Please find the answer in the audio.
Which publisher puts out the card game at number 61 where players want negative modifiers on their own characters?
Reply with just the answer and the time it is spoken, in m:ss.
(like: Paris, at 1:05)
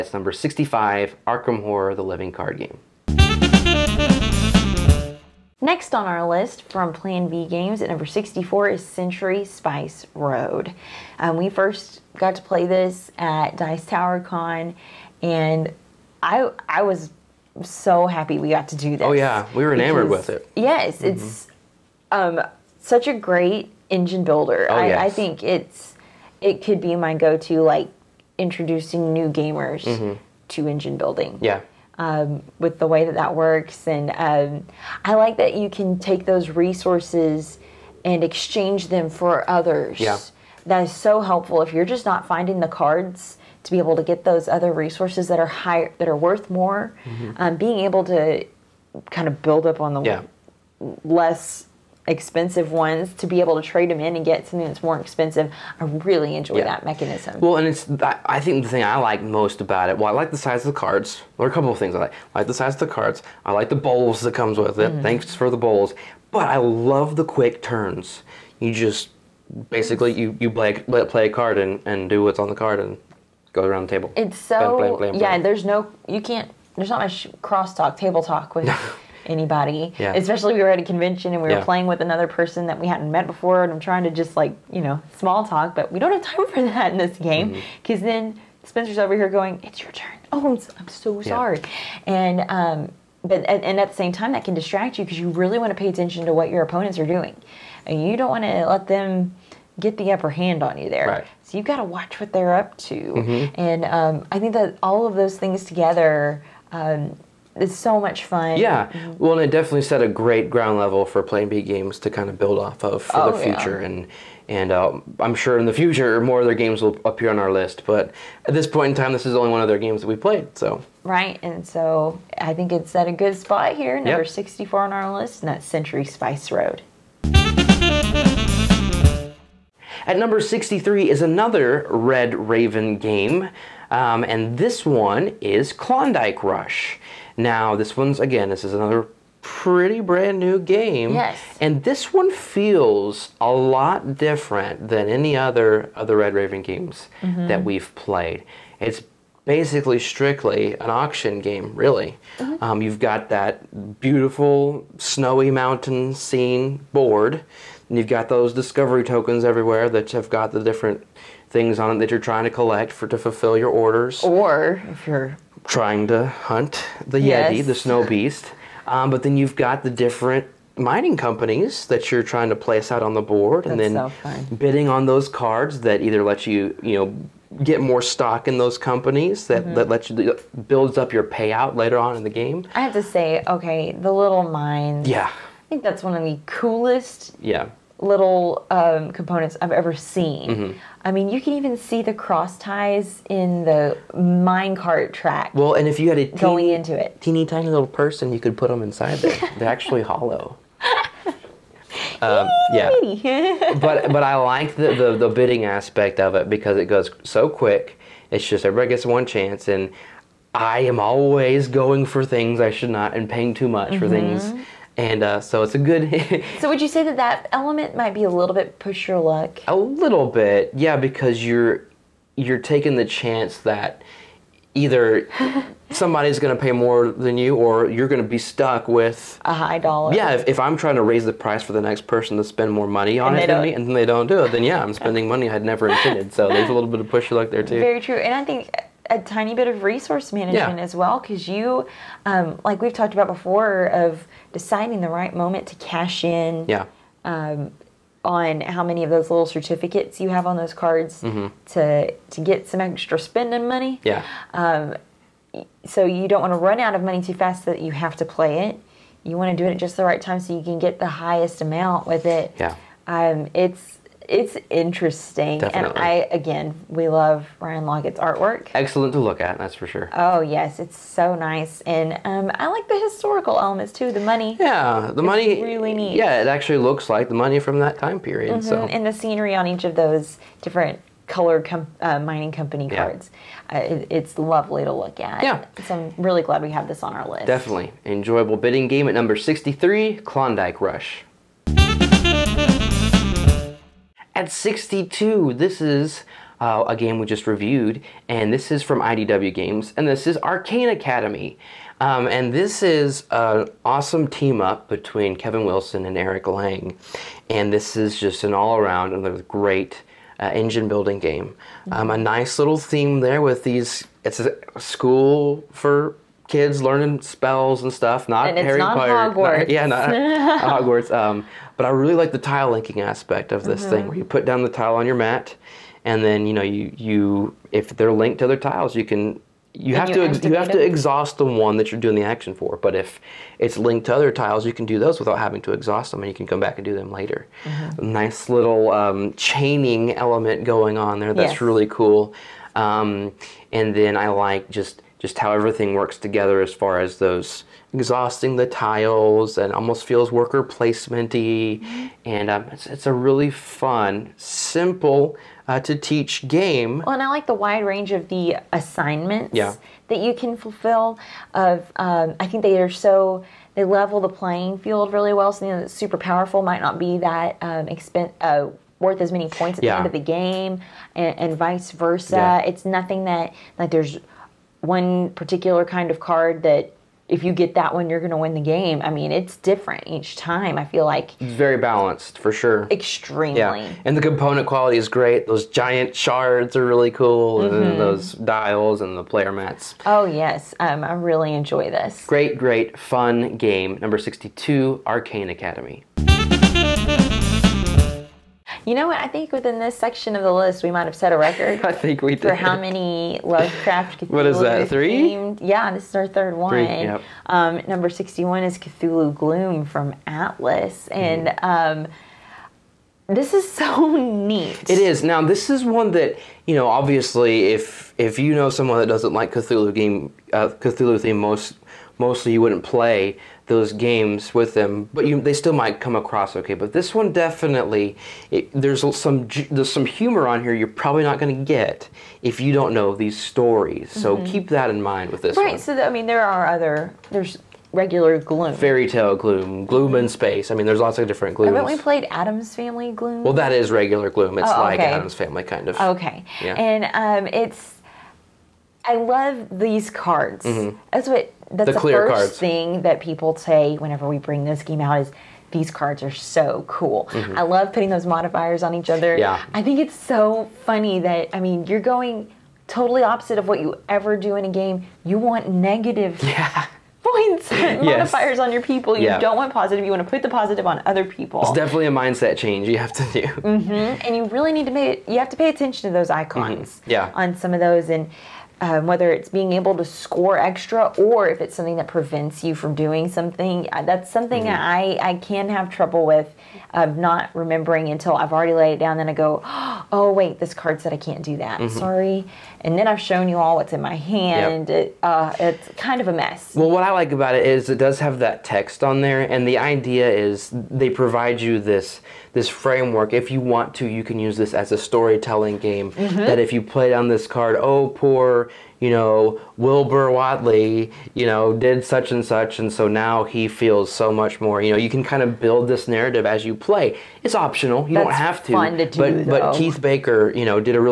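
Atlas, at 6:50.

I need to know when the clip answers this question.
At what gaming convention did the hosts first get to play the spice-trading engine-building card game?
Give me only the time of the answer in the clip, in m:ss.
0:13.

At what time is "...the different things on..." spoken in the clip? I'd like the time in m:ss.
2:40.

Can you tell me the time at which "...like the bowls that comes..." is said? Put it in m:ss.
1:03.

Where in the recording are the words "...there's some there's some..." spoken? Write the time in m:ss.
7:08.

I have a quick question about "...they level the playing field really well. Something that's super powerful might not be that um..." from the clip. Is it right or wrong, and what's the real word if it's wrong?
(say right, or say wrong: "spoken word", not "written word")
right.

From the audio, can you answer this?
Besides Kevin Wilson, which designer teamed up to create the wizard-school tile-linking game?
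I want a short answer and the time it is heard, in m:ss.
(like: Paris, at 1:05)
Eric Lang, at 5:06.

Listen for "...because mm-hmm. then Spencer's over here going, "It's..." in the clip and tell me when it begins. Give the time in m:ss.
1:27.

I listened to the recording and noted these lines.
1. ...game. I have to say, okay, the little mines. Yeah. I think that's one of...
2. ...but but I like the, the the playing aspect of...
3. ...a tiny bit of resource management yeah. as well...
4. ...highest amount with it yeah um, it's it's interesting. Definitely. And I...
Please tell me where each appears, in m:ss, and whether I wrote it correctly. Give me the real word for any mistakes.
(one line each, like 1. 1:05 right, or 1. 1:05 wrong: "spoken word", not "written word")
1. 3:02 right
2. 3:23 wrong: "bidding", not "playing"
3. 3:59 right
4. 4:21 right.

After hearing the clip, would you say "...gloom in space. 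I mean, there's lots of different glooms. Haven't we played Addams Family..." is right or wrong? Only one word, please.
right.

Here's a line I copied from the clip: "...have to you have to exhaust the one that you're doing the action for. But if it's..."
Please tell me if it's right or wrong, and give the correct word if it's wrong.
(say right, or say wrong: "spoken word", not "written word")
right.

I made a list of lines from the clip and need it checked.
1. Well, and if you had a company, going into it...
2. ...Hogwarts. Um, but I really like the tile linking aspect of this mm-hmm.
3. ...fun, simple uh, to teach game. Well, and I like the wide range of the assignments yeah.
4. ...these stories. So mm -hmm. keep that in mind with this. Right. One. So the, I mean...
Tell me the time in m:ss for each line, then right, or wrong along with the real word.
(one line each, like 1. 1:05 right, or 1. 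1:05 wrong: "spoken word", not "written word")
1. 3:15 wrong: "teeny", not "company"
2. 5:20 right
3. 5:53 right
4. 7:13 right.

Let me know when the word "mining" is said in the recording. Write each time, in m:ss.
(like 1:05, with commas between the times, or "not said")
2:50, 4:42.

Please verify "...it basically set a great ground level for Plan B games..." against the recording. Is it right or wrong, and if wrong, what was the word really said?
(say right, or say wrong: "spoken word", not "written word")
wrong: "definitely", not "basically".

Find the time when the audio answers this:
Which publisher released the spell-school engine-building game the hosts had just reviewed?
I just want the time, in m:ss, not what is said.
4:59.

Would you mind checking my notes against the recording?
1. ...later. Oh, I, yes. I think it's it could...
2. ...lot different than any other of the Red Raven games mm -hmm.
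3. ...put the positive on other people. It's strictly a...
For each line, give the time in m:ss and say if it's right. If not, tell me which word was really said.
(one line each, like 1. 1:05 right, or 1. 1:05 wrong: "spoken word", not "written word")
1. 0:24 wrong: "builder", not "later"
2. 2:23 right
3. 7:50 wrong: "definitely", not "strictly".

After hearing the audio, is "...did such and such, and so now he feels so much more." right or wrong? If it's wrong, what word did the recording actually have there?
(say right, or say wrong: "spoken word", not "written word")
right.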